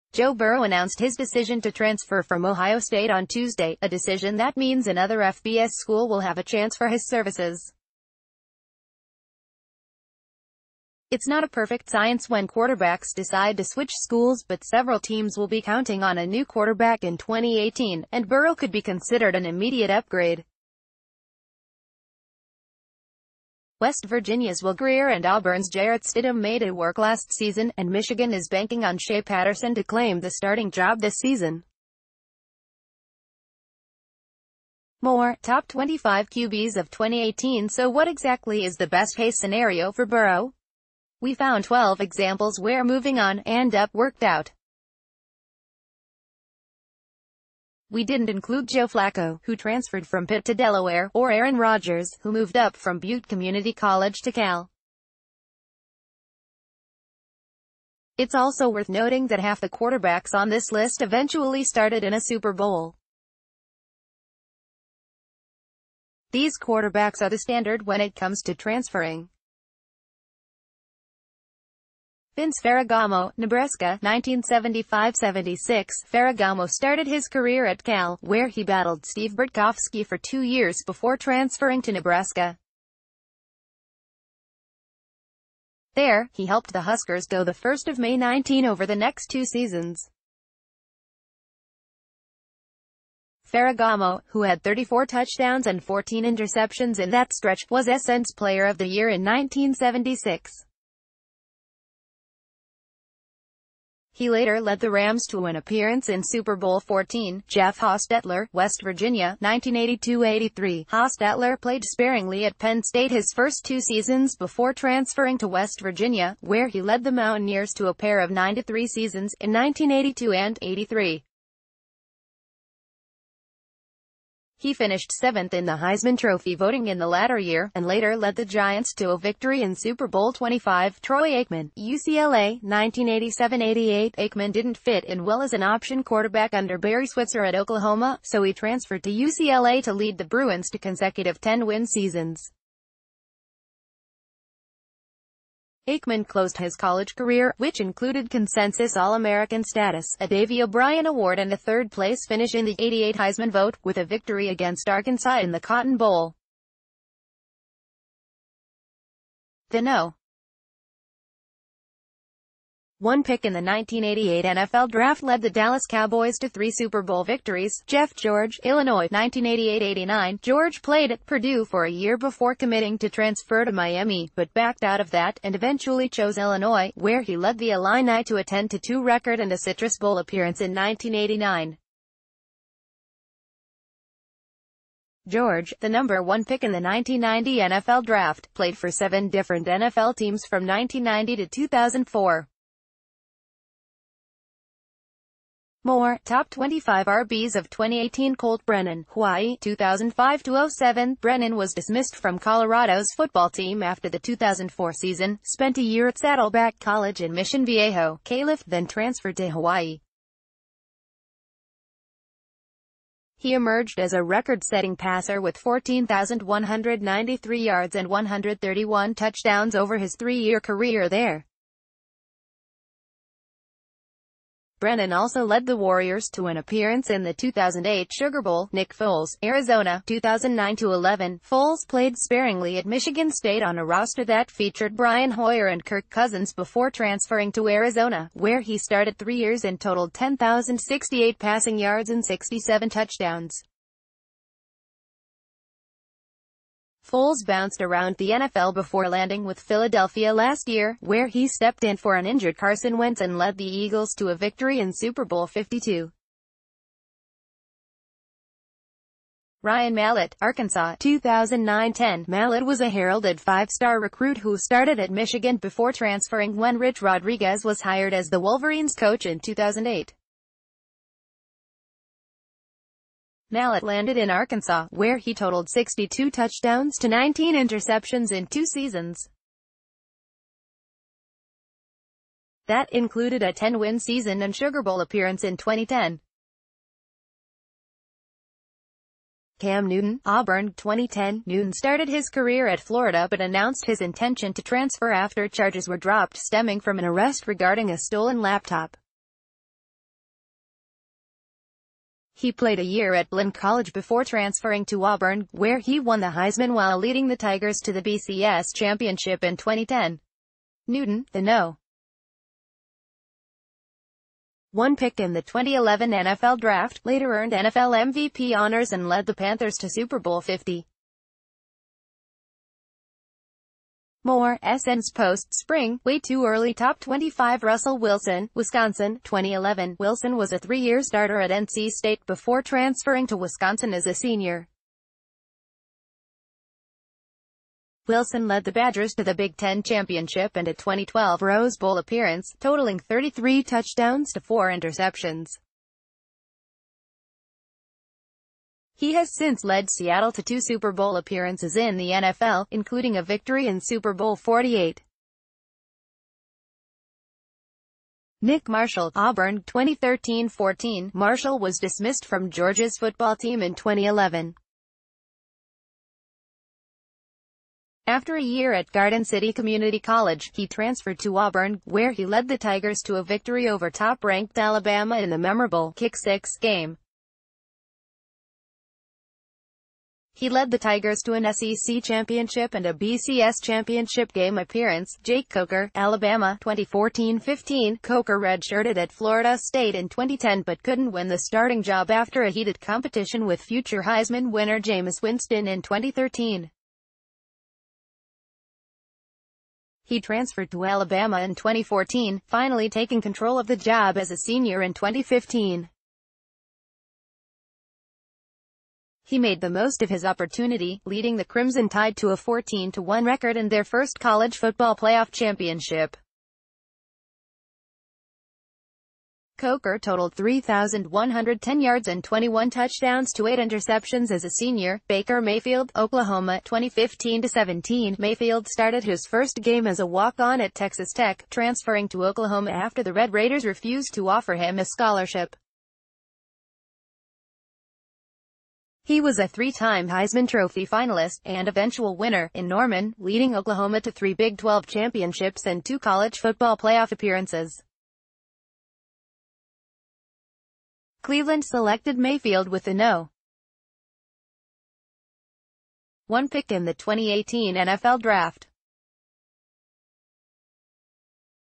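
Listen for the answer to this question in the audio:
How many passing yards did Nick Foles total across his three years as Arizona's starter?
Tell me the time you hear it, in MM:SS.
04:00.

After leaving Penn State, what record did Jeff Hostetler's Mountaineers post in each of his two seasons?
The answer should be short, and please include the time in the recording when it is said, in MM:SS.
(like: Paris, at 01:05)
9-3, at 01:58.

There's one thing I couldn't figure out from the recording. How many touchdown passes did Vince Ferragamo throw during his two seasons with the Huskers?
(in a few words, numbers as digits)
34.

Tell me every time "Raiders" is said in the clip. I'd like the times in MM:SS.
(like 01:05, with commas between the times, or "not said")
07:13.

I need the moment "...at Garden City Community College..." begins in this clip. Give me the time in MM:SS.
06:08.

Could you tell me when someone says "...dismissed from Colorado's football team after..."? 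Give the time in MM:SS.
03:21.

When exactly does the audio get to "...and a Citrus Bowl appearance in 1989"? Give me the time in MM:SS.
02:59.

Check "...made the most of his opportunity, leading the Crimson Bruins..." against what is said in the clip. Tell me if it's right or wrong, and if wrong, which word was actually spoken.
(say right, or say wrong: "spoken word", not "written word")
wrong: "Tide", not "Bruins".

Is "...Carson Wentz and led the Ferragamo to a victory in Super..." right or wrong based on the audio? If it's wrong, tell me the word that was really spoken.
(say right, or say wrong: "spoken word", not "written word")
wrong: "Eagles", not "Ferragamo".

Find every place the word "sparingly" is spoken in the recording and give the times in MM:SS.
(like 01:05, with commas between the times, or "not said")
01:51, 03:52.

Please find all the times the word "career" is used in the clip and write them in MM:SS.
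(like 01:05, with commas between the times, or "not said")
01:17, 02:27, 03:40, 04:52.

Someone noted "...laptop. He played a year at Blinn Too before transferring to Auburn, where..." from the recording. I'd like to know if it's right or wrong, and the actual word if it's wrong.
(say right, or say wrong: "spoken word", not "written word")
wrong: "College", not "Too".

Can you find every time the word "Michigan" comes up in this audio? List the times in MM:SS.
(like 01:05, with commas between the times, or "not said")
00:27, 03:52, 04:25.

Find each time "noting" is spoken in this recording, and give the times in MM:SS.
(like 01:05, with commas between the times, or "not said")
00:58.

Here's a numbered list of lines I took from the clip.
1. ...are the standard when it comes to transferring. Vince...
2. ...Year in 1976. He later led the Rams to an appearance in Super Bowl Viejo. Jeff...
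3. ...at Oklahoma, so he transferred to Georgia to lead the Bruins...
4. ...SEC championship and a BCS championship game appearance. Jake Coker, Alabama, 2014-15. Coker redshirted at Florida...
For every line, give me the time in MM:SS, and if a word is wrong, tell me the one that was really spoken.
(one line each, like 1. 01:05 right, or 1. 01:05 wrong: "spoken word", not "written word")
1. 01:07 right
2. 01:38 wrong: "XIV", not "Viejo"
3. 02:17 wrong: "UCLA", not "Georgia"
4. 06:21 right.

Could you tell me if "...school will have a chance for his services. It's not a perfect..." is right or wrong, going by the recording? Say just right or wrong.
right.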